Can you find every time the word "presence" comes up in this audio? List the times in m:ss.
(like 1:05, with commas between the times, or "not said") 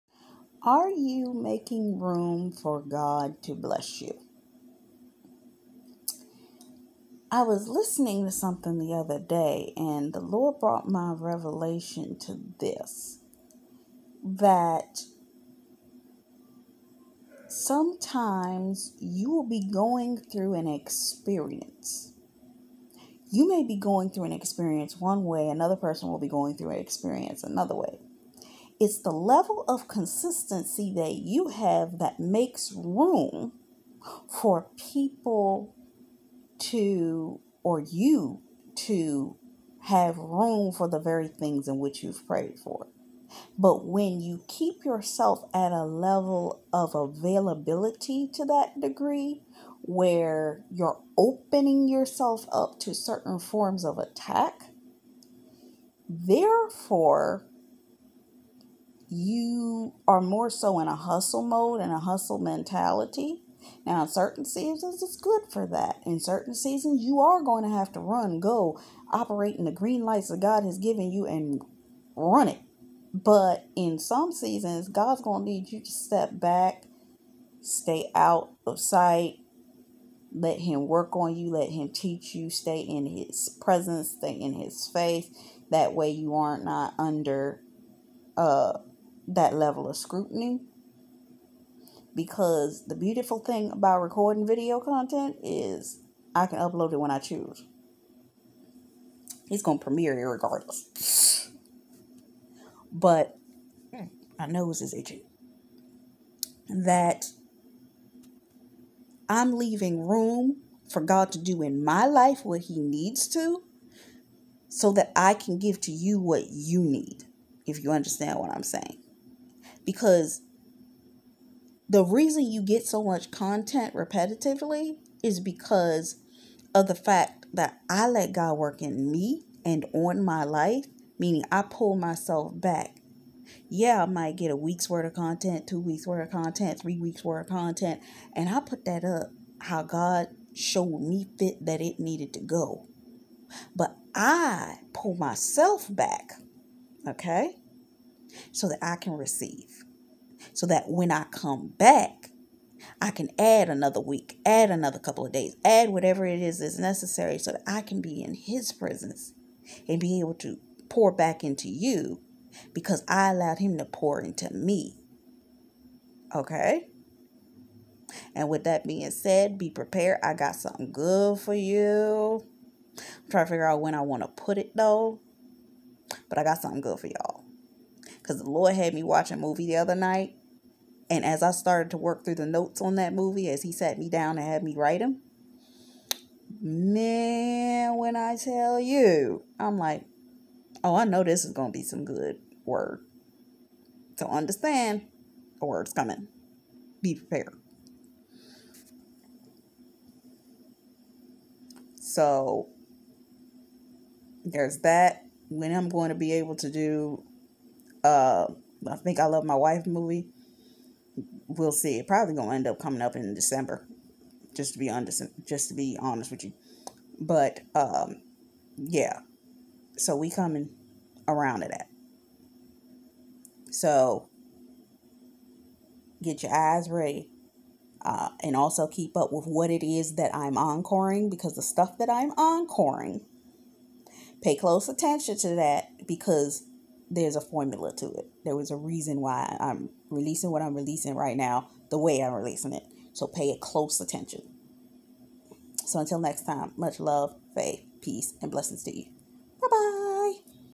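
1:23, 2:38.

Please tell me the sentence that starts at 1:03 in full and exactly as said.
Now, in certain seasons, it's good for that.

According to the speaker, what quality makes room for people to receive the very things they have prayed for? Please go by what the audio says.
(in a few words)
Level of consistency.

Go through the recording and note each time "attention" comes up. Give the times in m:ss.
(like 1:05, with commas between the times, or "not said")
3:54, 4:03.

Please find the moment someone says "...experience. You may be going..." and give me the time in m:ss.
0:20.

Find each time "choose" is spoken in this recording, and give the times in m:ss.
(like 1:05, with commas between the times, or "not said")
1:37.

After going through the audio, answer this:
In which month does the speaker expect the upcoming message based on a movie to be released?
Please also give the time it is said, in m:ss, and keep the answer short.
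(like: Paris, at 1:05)
December, at 3:33.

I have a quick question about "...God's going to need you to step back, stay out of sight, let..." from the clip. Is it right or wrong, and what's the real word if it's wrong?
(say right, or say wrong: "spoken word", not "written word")
right.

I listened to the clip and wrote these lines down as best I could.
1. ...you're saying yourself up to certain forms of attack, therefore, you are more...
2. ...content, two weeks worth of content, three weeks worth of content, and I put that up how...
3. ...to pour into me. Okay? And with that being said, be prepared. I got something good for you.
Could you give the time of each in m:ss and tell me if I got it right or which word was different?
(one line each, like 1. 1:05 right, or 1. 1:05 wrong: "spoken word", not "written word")
1. 0:50 wrong: "opening", not "saying"
2. 2:15 right
3. 2:43 right.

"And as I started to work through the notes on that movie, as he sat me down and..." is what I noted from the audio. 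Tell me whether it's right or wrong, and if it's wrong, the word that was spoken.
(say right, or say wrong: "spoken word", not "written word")
right.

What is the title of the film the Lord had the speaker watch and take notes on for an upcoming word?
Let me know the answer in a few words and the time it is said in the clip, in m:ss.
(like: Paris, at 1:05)
I Think I Love My Wife, at 3:28.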